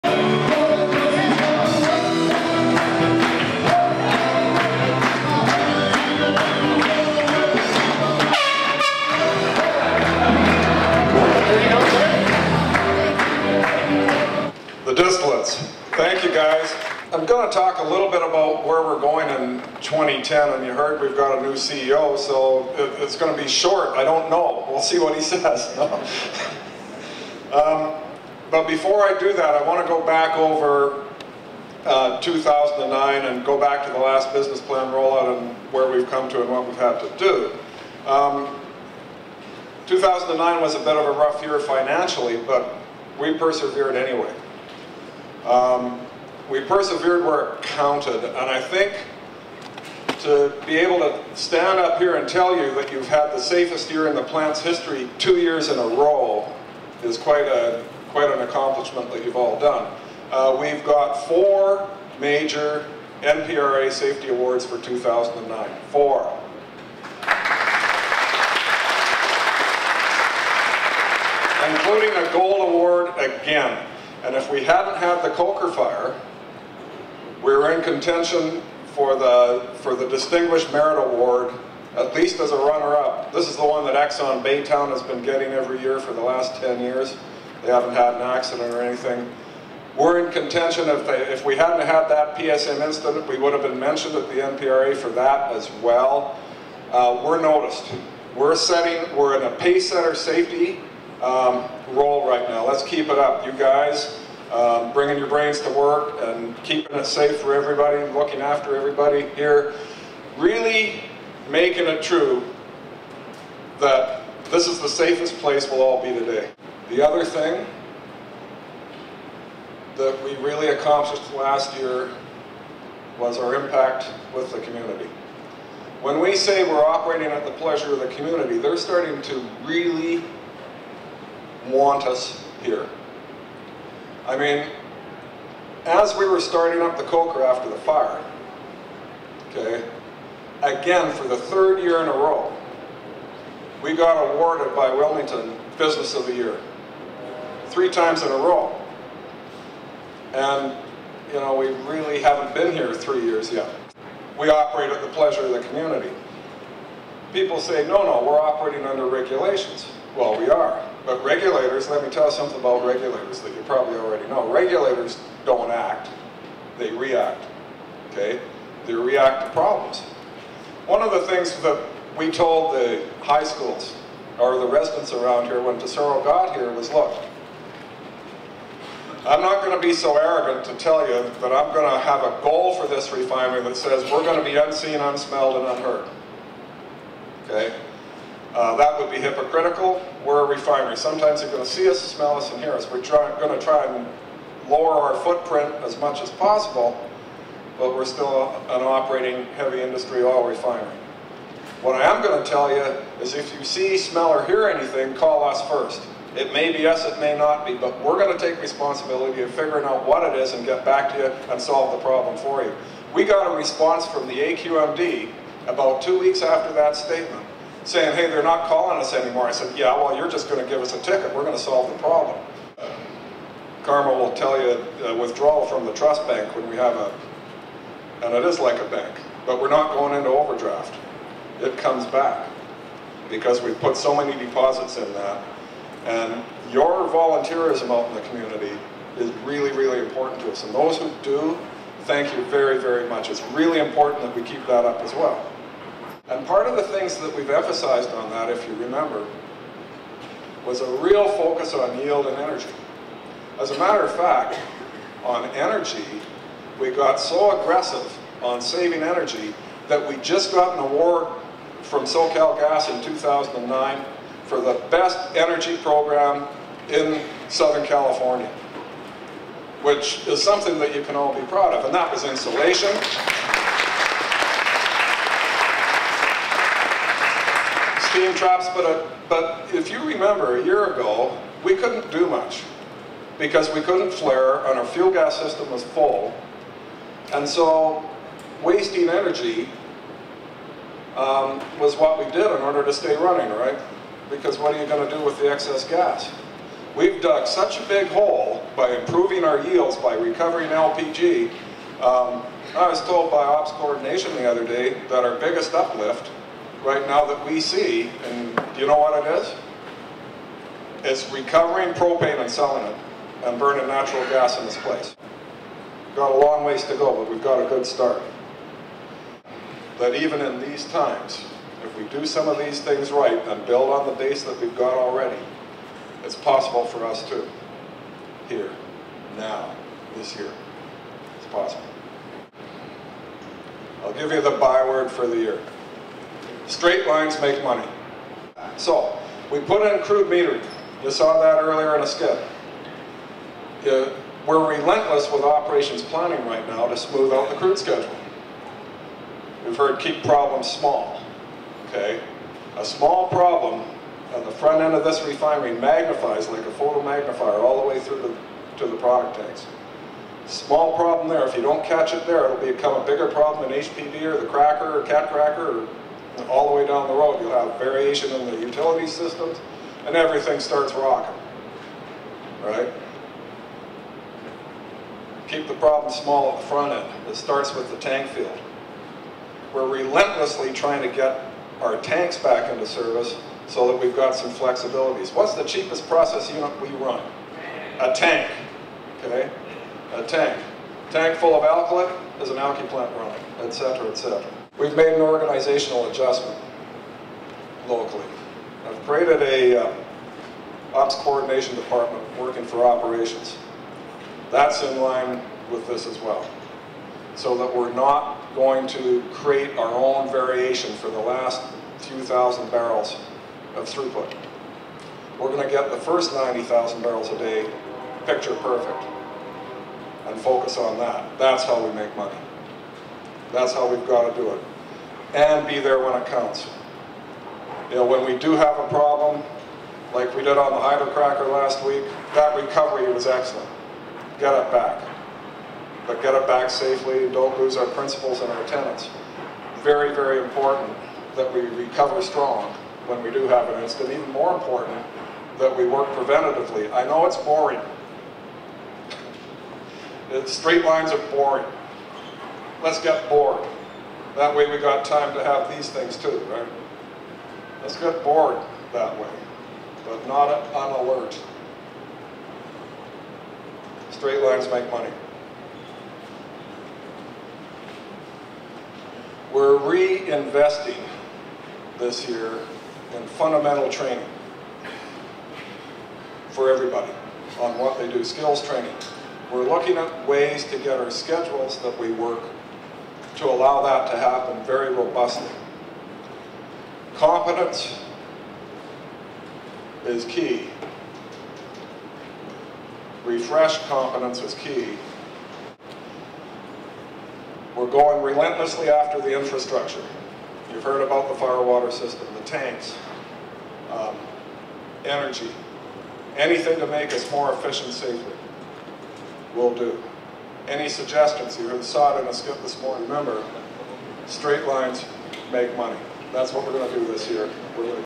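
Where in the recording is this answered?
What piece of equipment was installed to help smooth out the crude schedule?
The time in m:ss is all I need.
5:40.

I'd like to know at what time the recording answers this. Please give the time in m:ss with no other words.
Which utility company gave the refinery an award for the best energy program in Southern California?
4:22.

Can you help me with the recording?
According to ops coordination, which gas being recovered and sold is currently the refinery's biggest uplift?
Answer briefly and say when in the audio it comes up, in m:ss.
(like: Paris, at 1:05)
Propane, at 5:11.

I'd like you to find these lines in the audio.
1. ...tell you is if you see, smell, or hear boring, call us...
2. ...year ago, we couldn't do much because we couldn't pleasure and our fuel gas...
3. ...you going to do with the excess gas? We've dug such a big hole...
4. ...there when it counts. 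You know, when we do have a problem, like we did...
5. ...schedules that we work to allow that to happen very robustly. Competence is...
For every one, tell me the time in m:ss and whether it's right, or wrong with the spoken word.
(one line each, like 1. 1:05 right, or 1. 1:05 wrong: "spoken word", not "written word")
1. 3:22 wrong: "anything", not "boring"
2. 4:40 wrong: "flare", not "pleasure"
3. 4:54 right
4. 7:05 right
5. 8:01 right.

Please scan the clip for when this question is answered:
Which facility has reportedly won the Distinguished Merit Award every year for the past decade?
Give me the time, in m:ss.
1:23.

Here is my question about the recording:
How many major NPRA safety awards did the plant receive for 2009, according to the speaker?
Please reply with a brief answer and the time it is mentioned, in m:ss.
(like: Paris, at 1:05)
4, at 1:01.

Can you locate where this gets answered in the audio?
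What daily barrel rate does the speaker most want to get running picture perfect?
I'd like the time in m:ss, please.
6:56.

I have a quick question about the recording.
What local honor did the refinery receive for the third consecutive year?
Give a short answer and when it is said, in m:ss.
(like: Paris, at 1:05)
Business of the Year, at 2:25.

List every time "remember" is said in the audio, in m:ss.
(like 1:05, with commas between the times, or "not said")
4:08, 4:40, 8:33.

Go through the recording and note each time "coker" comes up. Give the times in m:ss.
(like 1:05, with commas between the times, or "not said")
1:15, 2:17.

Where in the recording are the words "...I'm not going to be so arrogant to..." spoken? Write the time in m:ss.
2:59.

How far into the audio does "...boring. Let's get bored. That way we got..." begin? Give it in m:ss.
7:31.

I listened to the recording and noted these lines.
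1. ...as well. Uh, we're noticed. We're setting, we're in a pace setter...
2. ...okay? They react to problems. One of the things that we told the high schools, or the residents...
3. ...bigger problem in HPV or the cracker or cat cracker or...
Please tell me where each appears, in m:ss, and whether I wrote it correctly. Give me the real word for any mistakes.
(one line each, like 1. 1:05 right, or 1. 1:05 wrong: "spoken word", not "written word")
1. 1:35 right
2. 2:48 right
3. 6:03 right.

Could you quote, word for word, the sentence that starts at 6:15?
Keep the problem small at the front end.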